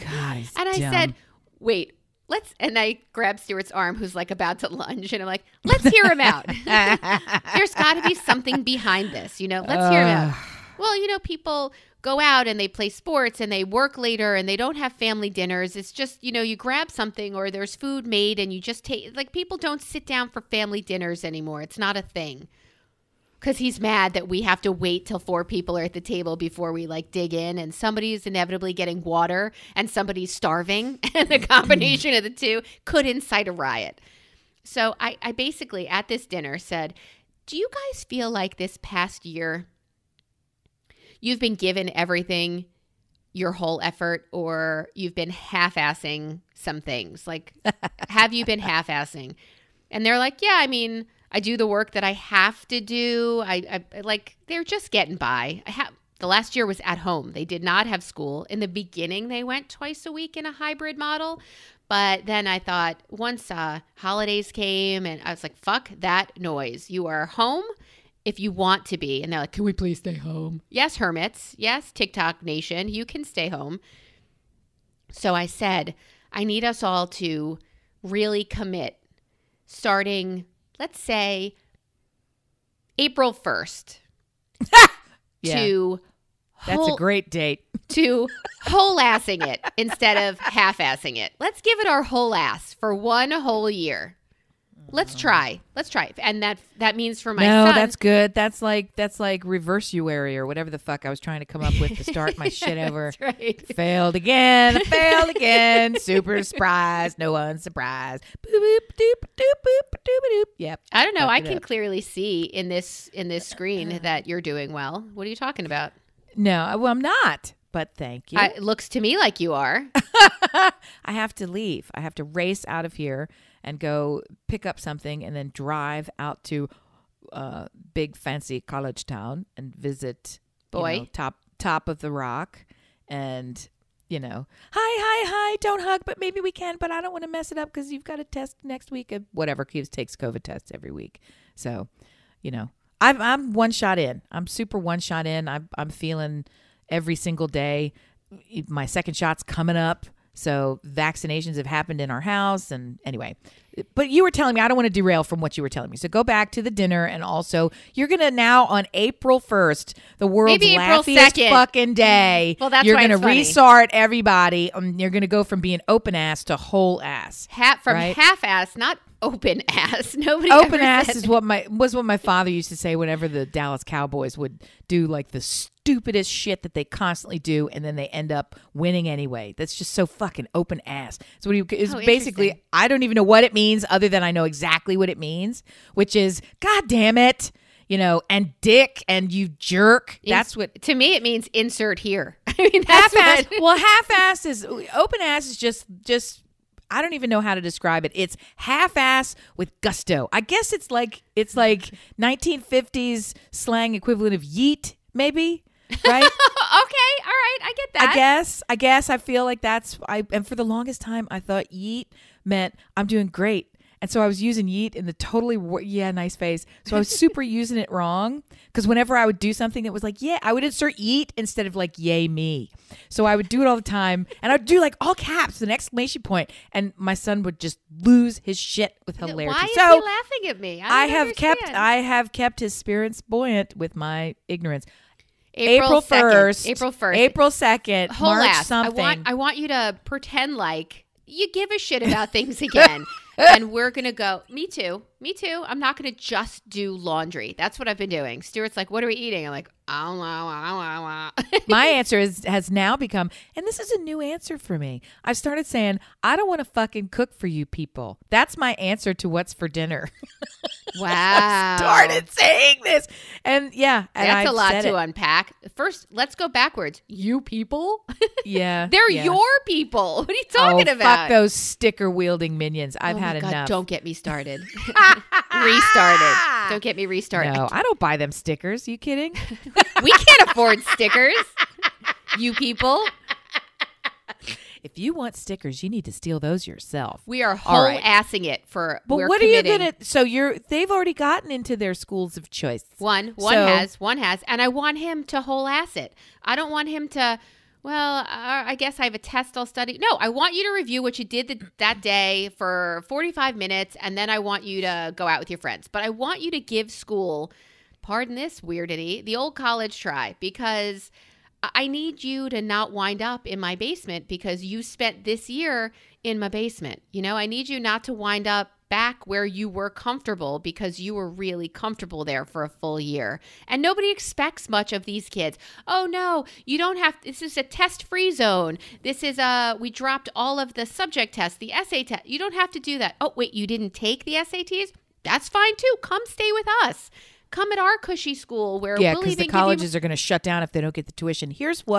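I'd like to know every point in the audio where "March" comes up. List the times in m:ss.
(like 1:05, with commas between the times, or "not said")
3:58.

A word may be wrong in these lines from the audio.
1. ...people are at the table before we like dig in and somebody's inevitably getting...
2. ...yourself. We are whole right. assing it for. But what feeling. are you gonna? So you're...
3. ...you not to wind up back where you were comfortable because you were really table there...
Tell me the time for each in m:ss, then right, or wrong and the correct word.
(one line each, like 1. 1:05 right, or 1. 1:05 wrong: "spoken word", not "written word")
1. 0:25 right
2. 4:46 wrong: "committing", not "feeling"
3. 5:17 wrong: "comfortable", not "table".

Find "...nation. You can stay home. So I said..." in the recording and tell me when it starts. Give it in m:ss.
1:12.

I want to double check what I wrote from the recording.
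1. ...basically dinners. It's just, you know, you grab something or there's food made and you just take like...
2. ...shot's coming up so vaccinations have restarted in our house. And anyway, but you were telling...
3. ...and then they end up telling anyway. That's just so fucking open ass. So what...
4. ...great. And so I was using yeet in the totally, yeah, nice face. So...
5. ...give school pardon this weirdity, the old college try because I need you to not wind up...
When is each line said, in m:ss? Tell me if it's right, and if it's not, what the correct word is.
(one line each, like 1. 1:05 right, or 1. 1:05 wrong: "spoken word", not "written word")
1. 0:14 wrong: "family", not "basically"
2. 2:29 wrong: "happened", not "restarted"
3. 2:57 wrong: "winning", not "telling"
4. 3:33 right
5. 5:06 right.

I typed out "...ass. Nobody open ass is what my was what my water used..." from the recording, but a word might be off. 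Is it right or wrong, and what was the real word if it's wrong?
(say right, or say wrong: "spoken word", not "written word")
wrong: "father", not "water".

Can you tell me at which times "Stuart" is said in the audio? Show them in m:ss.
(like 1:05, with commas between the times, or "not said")
0:03, 4:08.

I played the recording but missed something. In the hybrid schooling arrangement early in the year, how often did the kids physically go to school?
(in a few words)
twice a week.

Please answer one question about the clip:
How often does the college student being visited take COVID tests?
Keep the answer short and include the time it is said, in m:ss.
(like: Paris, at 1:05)
every week, at 2:20.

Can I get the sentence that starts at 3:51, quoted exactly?
kept, I have kept his spirits buoyant with my ignorance.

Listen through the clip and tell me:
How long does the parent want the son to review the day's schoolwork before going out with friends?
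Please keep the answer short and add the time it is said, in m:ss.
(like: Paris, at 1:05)
45 minutes, at 5:03.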